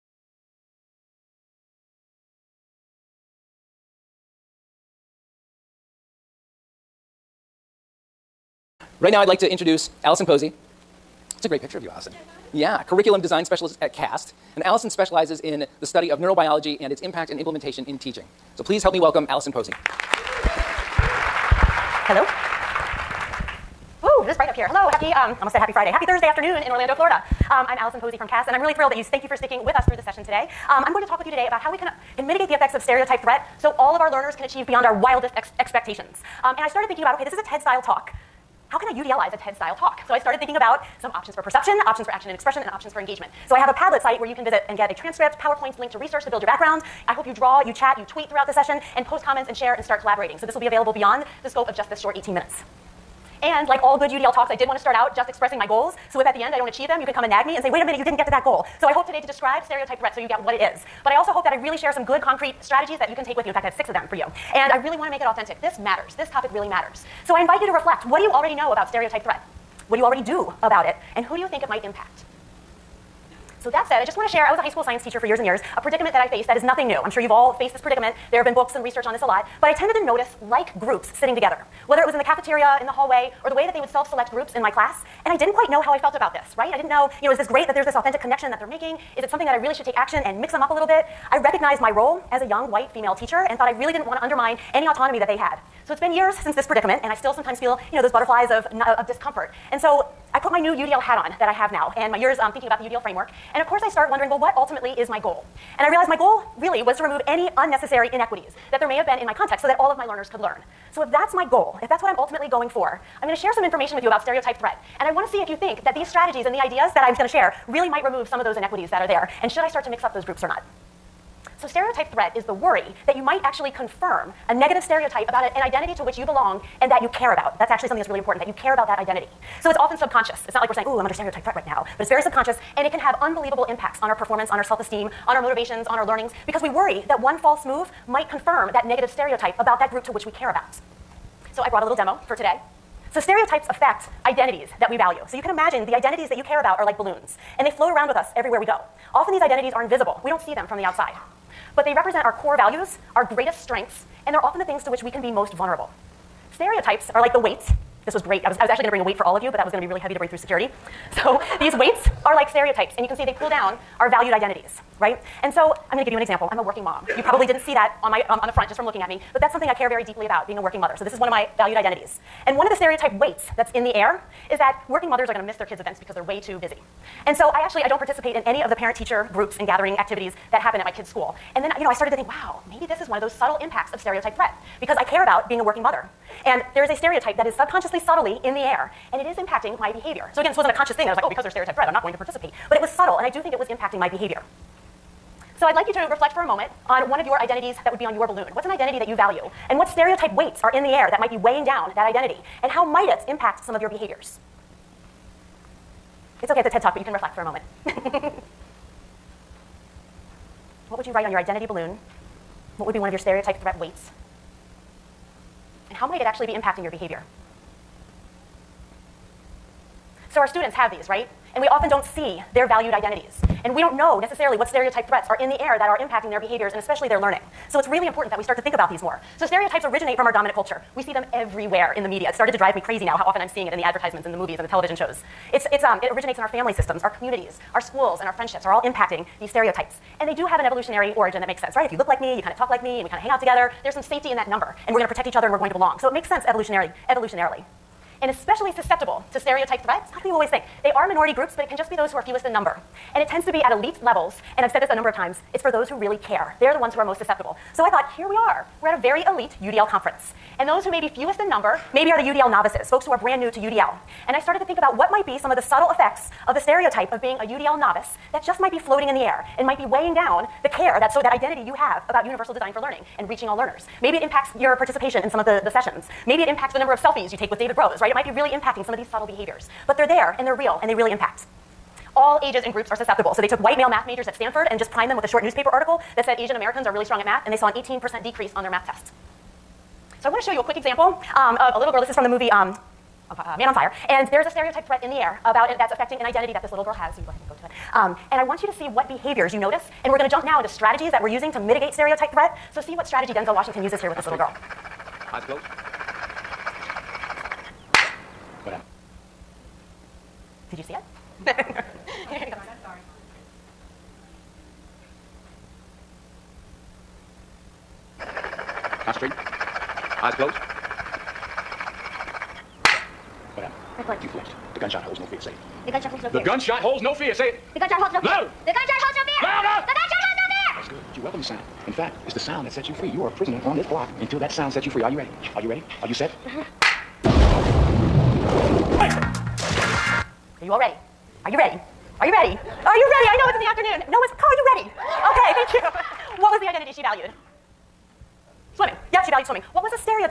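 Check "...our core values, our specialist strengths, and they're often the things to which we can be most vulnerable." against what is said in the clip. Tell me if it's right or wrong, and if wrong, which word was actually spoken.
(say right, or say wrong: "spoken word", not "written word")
wrong: "greatest", not "specialist".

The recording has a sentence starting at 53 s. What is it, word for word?
And like all good UDL talks, I did want to start out just expressing my goals.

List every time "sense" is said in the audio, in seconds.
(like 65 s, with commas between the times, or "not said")
241 s, 246 s.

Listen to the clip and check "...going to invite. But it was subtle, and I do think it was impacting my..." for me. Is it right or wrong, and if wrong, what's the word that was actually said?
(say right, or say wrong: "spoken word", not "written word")
wrong: "participate", not "invite".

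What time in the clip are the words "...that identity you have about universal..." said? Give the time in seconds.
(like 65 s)
271 s.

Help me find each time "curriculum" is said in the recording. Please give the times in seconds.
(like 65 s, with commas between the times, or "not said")
12 s.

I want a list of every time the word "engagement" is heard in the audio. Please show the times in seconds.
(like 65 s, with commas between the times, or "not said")
42 s.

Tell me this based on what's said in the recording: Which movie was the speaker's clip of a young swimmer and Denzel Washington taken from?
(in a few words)
Man on Fire.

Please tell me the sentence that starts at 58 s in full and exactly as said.
So I hope today to describe stereotype threat so you get what it is.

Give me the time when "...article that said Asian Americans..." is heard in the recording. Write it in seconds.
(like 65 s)
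285 s.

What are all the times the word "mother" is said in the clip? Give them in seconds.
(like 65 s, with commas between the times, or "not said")
170 s, 175 s, 185 s.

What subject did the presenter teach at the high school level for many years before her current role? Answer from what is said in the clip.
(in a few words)
science.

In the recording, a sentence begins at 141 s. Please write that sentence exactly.
So I brought a little demo for today.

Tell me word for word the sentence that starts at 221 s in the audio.
And we often don't see their valued identities.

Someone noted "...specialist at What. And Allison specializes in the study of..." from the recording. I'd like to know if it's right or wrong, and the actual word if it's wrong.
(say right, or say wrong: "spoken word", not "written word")
wrong: "CAST", not "What".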